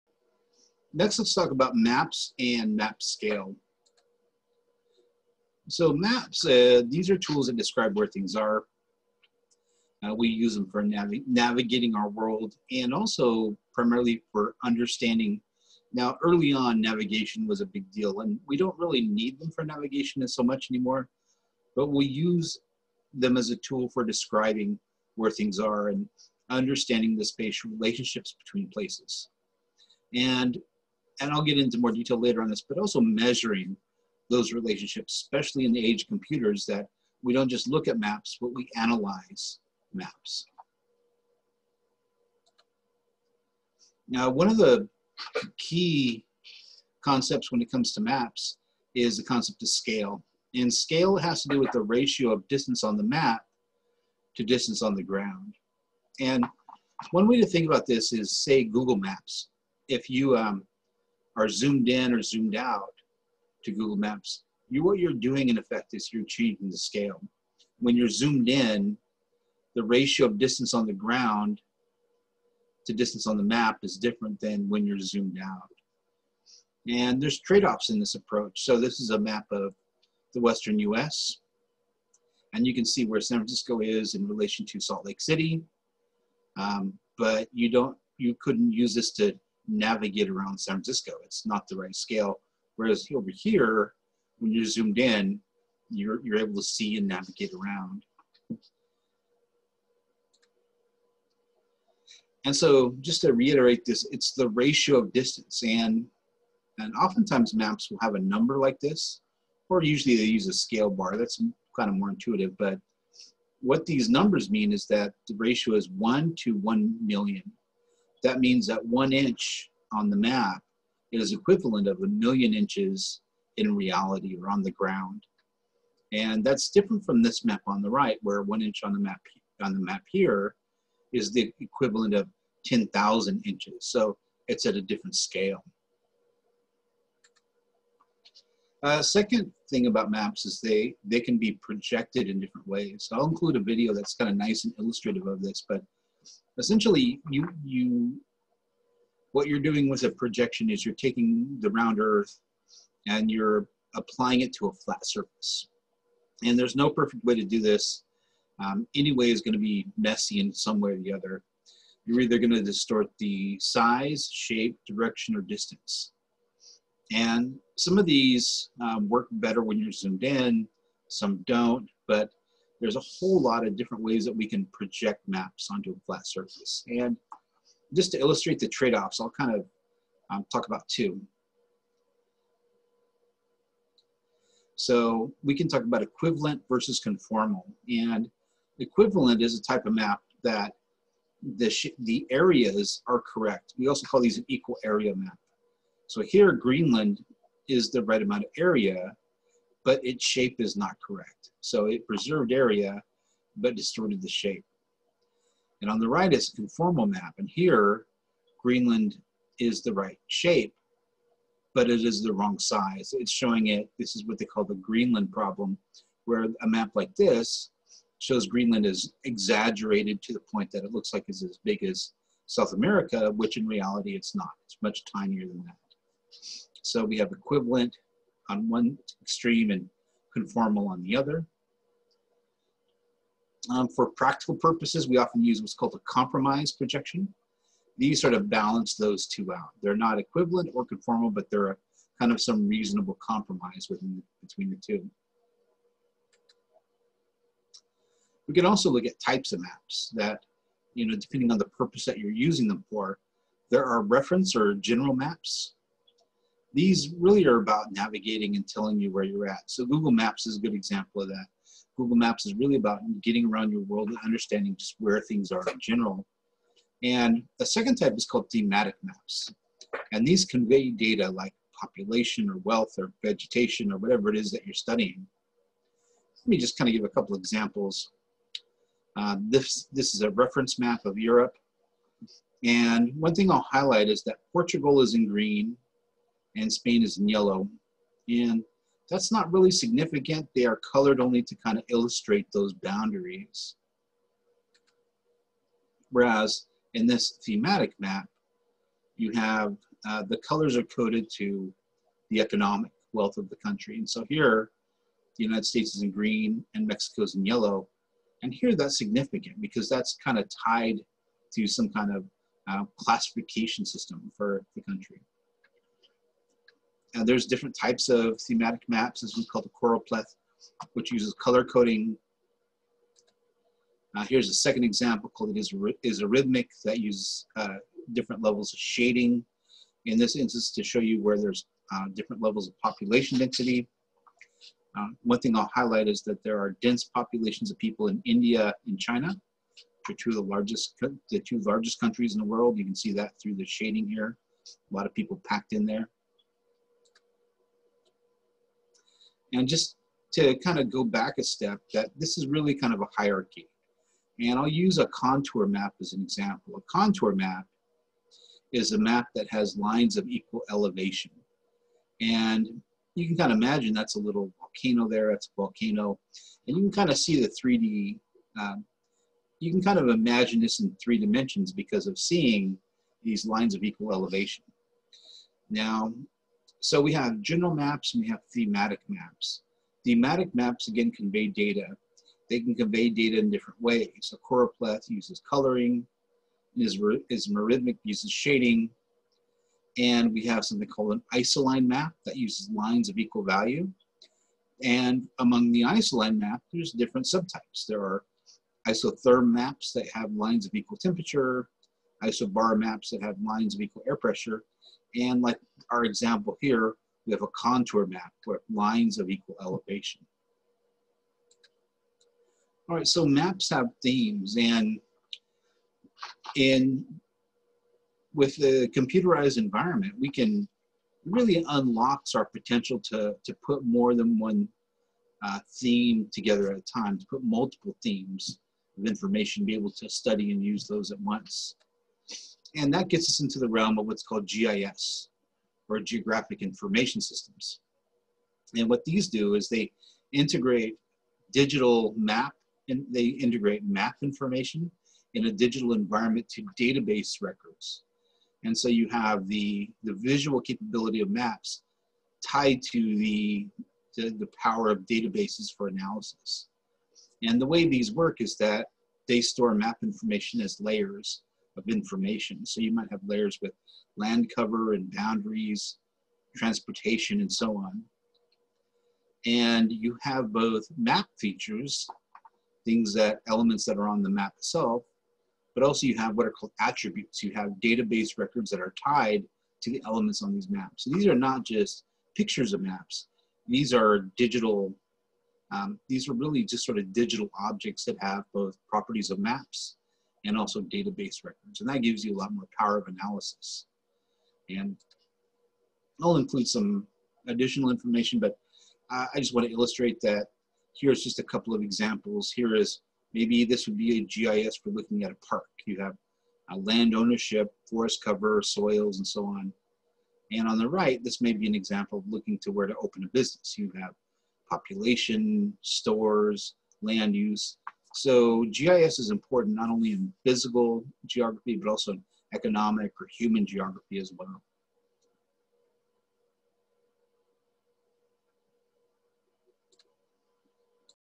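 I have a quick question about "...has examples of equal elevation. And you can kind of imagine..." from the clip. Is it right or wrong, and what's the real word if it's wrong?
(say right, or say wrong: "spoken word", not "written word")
wrong: "lines", not "examples".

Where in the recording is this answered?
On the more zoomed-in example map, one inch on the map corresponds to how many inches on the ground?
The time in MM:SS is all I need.
02:12.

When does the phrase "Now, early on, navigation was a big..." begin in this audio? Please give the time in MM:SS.
00:15.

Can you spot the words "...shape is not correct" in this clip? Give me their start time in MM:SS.
03:20.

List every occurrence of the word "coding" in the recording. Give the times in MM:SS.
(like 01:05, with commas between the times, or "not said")
05:21.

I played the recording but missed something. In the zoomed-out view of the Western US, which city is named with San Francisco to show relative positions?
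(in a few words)
Salt Lake City.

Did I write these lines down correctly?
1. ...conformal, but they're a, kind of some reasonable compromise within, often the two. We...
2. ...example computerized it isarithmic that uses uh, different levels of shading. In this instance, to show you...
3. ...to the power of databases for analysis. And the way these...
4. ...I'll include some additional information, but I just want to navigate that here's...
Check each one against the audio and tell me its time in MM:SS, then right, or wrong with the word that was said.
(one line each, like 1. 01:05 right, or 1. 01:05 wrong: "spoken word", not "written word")
1. 04:00 wrong: "between", not "often"
2. 05:24 wrong: "called", not "computerized"
3. 07:34 right
4. 08:16 wrong: "illustrate", not "navigate".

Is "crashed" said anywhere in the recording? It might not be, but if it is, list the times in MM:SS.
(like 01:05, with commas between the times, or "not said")
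not said.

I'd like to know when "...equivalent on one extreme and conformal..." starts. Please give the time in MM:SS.
03:47.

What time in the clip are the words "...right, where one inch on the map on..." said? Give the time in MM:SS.
02:07.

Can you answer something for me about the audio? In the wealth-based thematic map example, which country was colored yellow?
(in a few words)
Mexico.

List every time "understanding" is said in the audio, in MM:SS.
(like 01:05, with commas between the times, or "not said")
00:14, 00:26, 04:24.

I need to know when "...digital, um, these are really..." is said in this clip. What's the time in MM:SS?
08:04.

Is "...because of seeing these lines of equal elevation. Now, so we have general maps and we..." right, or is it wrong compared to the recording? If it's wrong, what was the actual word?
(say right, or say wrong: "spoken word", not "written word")
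right.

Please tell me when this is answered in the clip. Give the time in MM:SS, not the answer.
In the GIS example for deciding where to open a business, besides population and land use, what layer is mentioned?
08:35.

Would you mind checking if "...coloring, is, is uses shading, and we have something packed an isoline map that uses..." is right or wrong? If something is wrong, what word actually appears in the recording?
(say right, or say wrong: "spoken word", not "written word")
wrong: "called", not "packed".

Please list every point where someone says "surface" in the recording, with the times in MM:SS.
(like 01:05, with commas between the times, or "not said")
02:35, 02:56.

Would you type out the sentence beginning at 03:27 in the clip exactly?
And here, Greenland is the right shape, but it is the wrong size.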